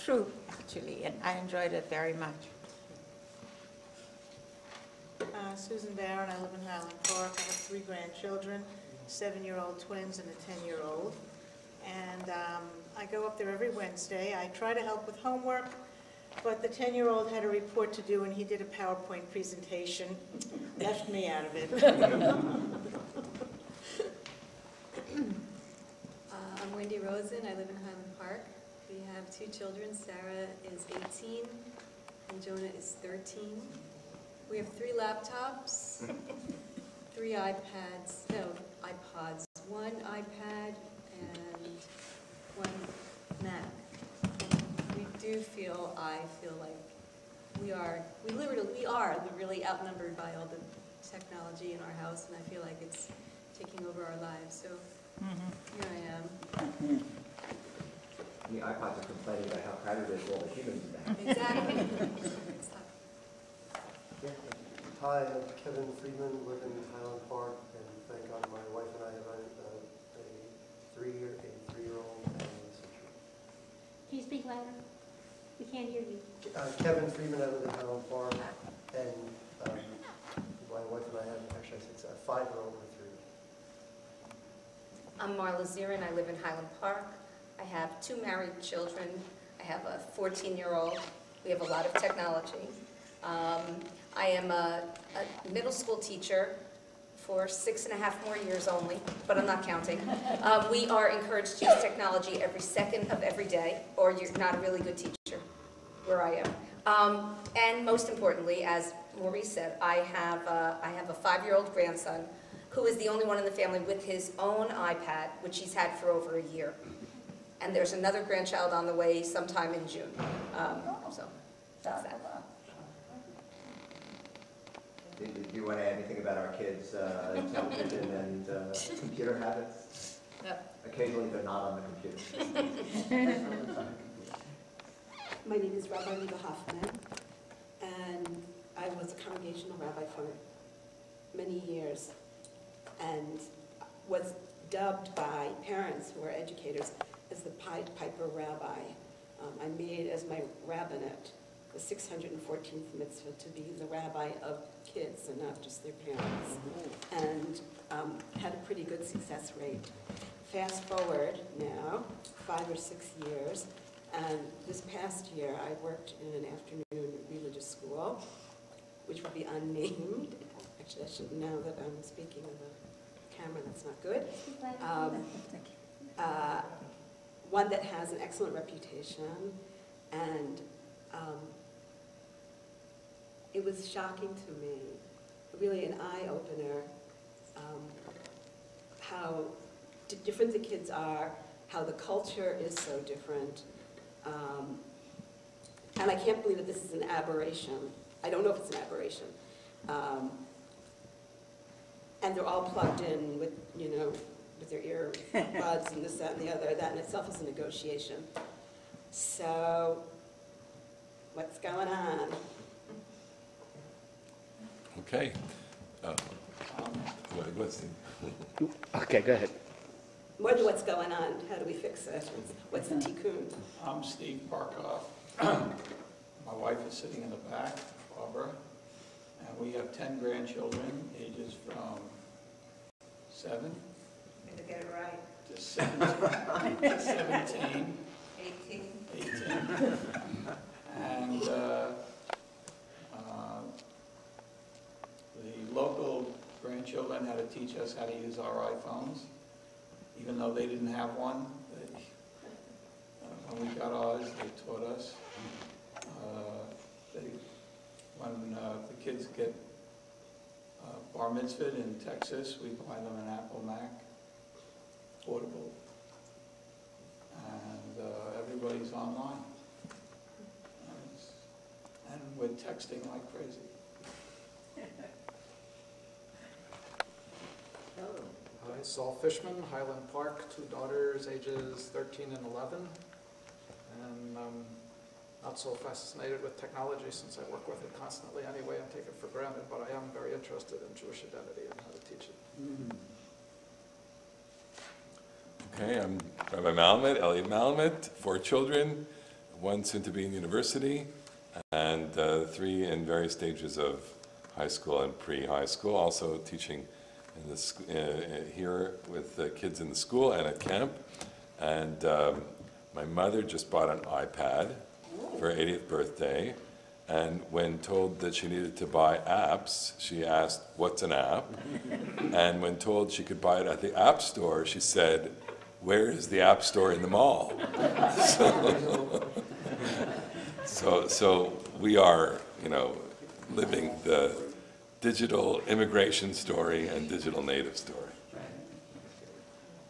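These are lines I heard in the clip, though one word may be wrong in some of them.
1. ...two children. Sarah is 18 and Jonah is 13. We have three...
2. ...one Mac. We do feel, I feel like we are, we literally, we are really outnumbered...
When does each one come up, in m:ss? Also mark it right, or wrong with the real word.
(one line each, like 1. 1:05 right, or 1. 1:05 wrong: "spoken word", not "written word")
1. 0:29 right
2. 0:42 right.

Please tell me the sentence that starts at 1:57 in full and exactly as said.
And there's another grandchild on the way sometime in June.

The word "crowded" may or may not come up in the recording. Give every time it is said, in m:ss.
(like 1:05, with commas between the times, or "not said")
0:59.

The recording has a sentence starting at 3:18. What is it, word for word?
I don't know if it's an aberration.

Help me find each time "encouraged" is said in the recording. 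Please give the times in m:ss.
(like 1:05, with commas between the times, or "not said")
1:41.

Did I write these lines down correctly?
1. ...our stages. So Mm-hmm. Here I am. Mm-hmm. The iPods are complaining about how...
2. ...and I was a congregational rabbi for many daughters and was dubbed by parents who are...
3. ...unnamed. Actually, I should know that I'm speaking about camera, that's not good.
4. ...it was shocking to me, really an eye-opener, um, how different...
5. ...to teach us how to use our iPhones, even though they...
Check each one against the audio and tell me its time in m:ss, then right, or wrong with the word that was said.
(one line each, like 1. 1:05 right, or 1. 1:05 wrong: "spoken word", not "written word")
1. 0:54 wrong: "lives", not "stages"
2. 2:17 wrong: "years", not "daughters"
3. 2:49 right
4. 3:03 right
5. 4:07 right.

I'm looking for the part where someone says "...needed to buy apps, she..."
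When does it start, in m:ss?
5:18.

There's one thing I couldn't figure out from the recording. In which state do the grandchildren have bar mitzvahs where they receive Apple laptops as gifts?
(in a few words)
Texas.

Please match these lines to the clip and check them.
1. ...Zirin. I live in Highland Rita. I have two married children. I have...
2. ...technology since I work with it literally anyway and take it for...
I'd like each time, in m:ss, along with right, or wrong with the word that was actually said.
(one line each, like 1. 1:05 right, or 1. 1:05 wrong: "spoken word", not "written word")
1. 1:25 wrong: "Park", not "Rita"
2. 4:46 wrong: "constantly", not "literally".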